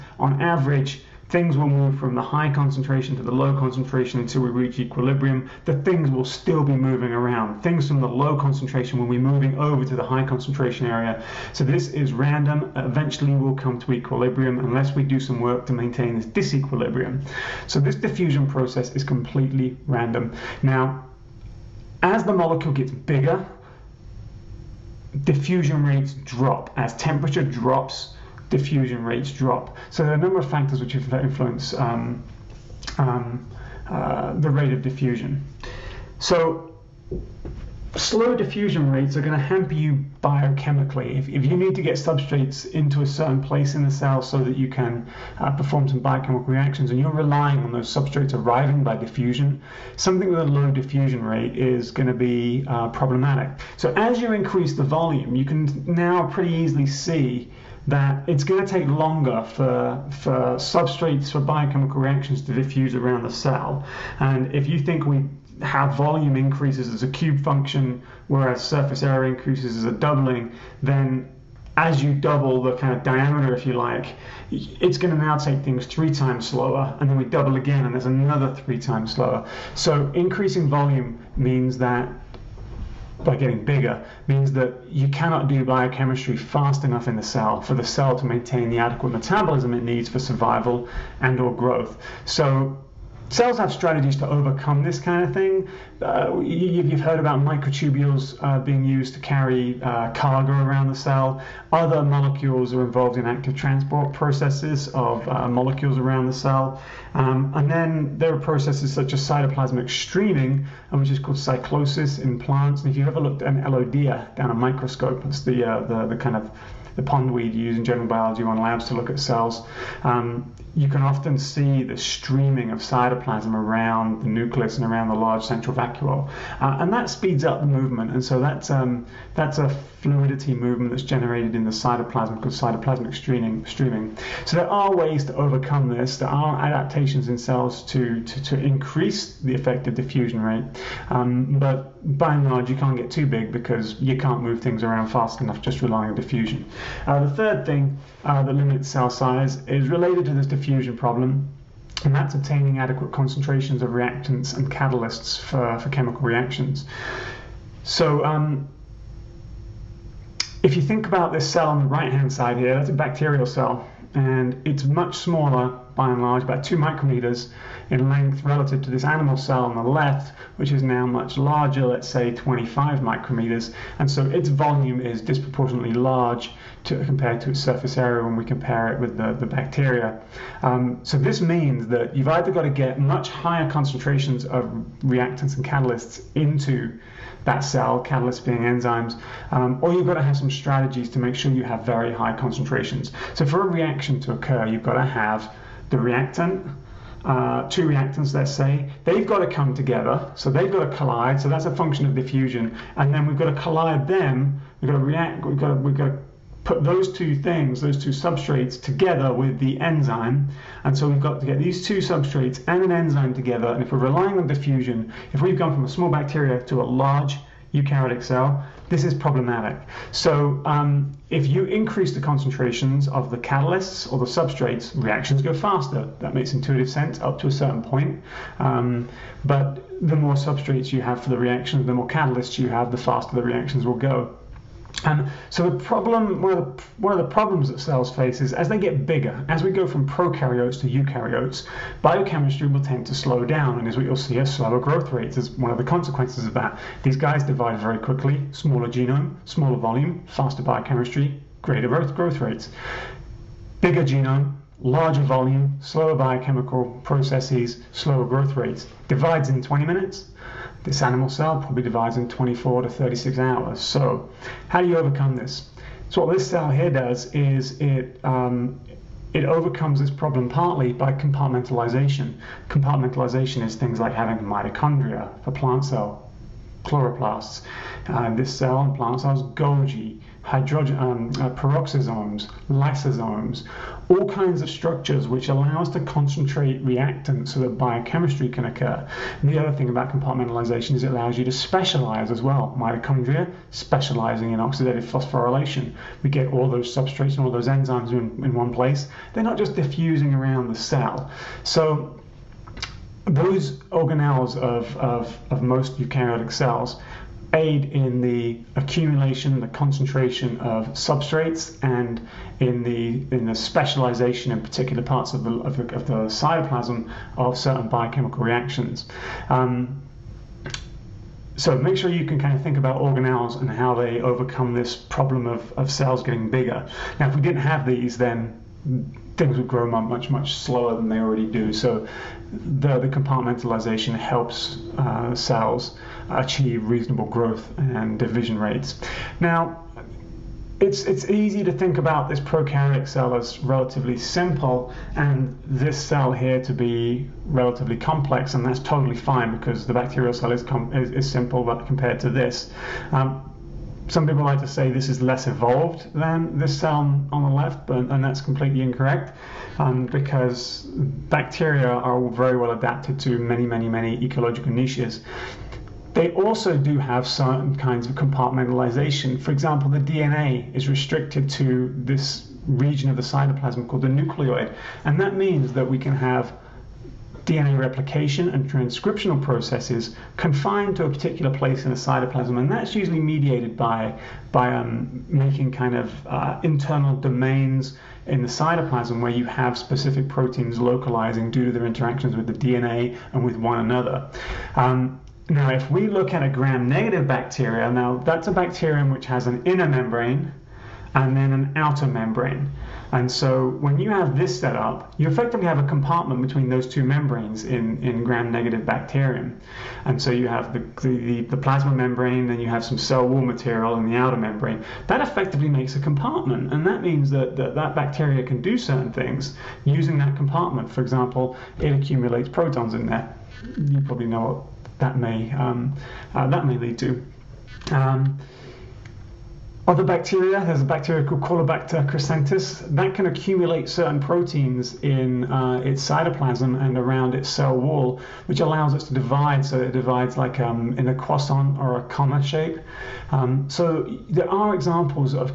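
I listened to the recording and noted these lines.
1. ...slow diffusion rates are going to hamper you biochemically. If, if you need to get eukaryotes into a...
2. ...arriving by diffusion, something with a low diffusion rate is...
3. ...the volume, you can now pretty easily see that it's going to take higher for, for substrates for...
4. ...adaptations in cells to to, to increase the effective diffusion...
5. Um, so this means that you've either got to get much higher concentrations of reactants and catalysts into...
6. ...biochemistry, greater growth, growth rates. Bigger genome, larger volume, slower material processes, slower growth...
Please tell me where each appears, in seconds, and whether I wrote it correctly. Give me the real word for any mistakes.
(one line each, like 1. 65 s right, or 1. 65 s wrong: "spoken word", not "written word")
1. 37 s wrong: "substrates", not "eukaryotes"
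2. 48 s right
3. 54 s wrong: "longer", not "higher"
4. 136 s right
5. 180 s right
6. 250 s wrong: "biochemical", not "material".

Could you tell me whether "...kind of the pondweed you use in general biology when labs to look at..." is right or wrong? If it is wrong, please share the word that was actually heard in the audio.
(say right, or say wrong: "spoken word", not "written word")
right.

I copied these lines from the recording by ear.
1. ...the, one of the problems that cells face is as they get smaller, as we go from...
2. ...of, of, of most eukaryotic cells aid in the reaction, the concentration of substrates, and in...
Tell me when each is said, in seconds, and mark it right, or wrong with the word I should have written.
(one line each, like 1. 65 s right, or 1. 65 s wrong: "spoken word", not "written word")
1. 236 s wrong: "bigger", not "smaller"
2. 304 s wrong: "accumulation", not "reaction".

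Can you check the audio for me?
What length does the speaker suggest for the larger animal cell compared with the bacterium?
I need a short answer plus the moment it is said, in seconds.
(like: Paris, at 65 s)
25 micrometers, at 172 s.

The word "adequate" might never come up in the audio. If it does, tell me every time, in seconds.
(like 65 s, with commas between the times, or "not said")
88 s, 152 s.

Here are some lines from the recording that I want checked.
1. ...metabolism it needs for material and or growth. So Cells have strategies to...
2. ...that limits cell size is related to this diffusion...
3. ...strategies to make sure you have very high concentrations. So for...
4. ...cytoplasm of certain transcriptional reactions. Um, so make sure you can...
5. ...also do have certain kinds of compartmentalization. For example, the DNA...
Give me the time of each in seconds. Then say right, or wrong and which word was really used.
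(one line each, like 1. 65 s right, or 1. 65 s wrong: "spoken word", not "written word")
1. 89 s wrong: "survival", not "material"
2. 148 s right
3. 190 s right
4. 316 s wrong: "biochemical", not "transcriptional"
5. 366 s right.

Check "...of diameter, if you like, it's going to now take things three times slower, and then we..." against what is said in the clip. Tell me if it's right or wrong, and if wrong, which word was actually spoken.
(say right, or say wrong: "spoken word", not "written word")
right.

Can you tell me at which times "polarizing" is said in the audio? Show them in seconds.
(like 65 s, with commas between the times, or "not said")
not said.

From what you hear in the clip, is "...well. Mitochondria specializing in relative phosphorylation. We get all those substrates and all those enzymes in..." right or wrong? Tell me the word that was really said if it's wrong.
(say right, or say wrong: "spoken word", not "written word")
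wrong: "oxidative", not "relative".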